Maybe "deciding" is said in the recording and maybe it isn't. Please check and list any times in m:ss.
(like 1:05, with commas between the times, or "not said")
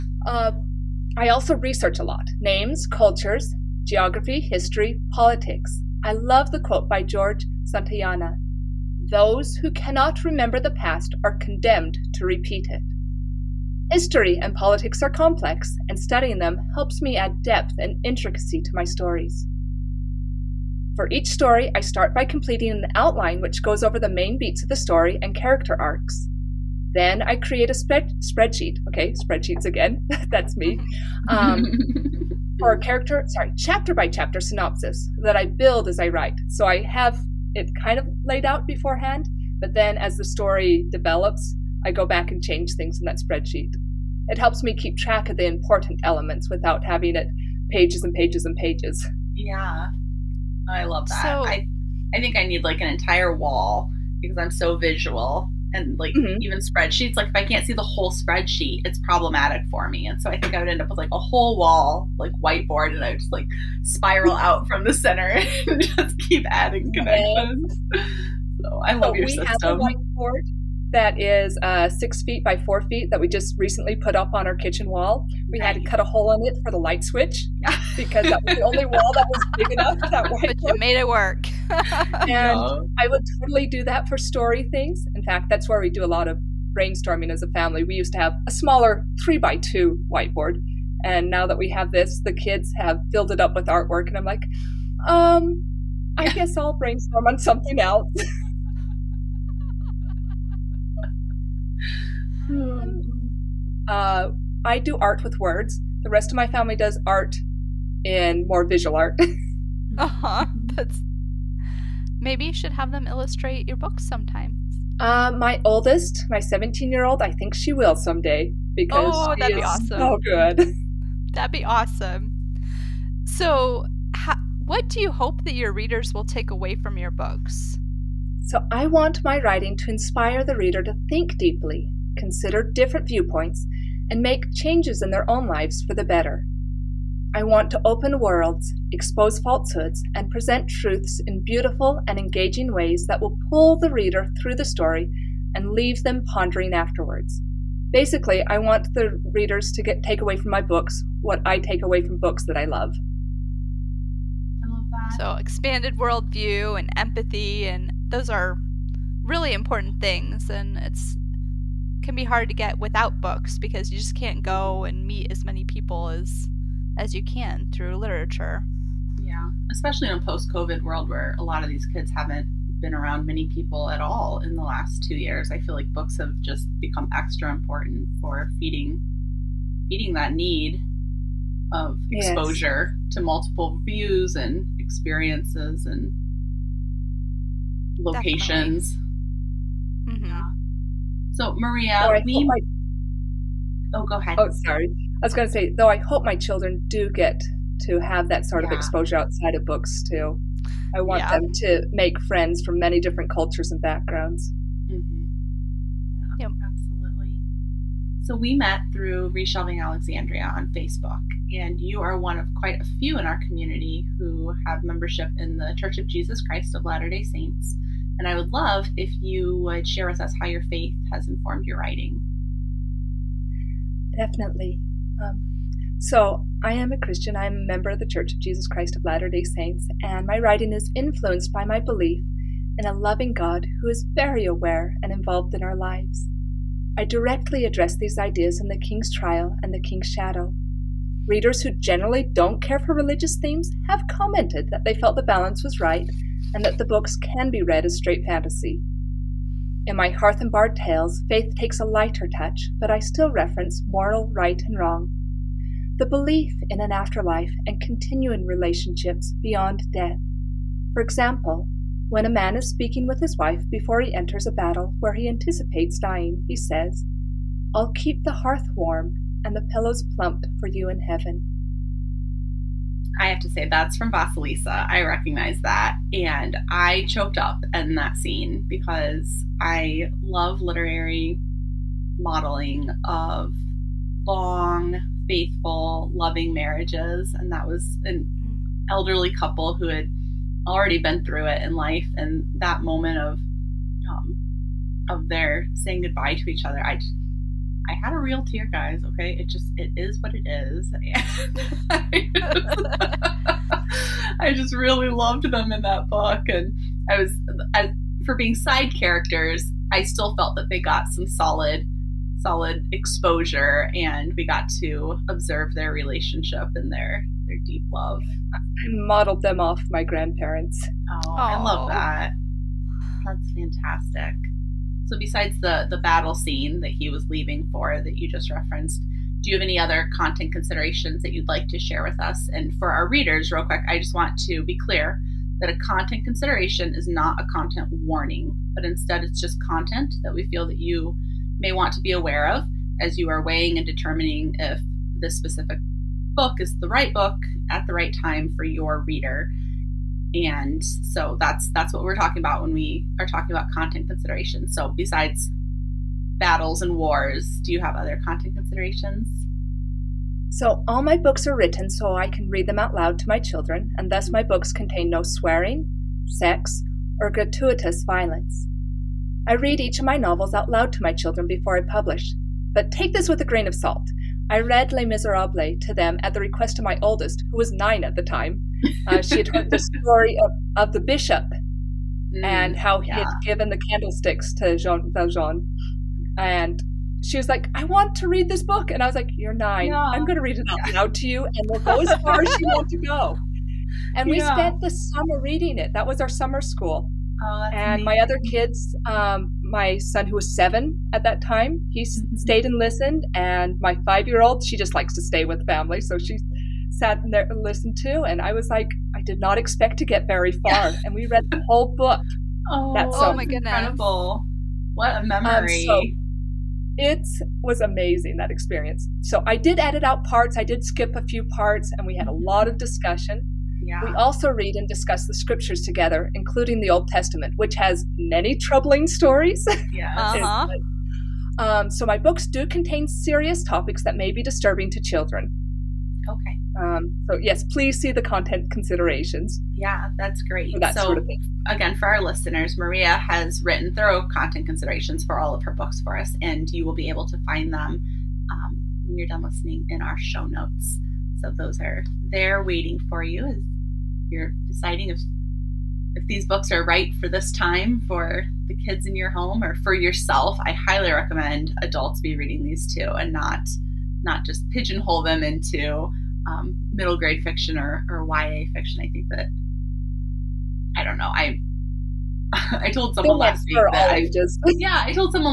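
7:34.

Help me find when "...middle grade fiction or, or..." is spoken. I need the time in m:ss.
7:46.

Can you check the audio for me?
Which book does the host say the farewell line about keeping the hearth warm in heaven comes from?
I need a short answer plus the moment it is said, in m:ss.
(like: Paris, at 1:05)
Vasilisa, at 4:34.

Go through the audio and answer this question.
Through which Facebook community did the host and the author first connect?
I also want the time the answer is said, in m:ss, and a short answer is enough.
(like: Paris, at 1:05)
Reshelving Alexandria, at 3:29.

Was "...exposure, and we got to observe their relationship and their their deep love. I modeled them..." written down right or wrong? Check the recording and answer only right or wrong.
right.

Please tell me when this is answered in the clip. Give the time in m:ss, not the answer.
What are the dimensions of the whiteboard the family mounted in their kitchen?
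1:11.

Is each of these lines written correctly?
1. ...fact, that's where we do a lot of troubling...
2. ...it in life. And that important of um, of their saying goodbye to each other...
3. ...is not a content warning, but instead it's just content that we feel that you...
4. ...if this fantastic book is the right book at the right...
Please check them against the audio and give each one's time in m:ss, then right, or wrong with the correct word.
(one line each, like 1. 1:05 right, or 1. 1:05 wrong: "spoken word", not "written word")
1. 1:25 wrong: "brainstorming", not "troubling"
2. 4:51 wrong: "moment", not "important"
3. 5:36 right
4. 5:44 wrong: "specific", not "fantastic".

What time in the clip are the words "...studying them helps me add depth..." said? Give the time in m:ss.
0:16.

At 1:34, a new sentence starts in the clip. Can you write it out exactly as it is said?
And I'm like, um, I guess I'll brainstorm on something else.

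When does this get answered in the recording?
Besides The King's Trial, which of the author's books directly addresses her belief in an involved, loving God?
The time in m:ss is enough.
3:59.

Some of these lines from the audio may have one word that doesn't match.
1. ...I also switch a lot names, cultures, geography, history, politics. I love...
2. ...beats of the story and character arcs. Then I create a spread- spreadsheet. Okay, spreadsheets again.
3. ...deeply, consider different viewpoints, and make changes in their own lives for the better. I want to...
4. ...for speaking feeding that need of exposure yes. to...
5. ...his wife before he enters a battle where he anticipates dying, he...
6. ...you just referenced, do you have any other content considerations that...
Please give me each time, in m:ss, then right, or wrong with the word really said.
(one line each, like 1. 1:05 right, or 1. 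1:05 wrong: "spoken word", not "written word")
1. 0:01 wrong: "research", not "switch"
2. 0:24 right
3. 2:11 right
4. 2:58 wrong: "feeding", not "speaking"
5. 4:23 right
6. 5:28 right.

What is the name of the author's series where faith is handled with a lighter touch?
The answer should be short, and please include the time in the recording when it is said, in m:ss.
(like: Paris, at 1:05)
Hearth and Bard tales, at 4:10.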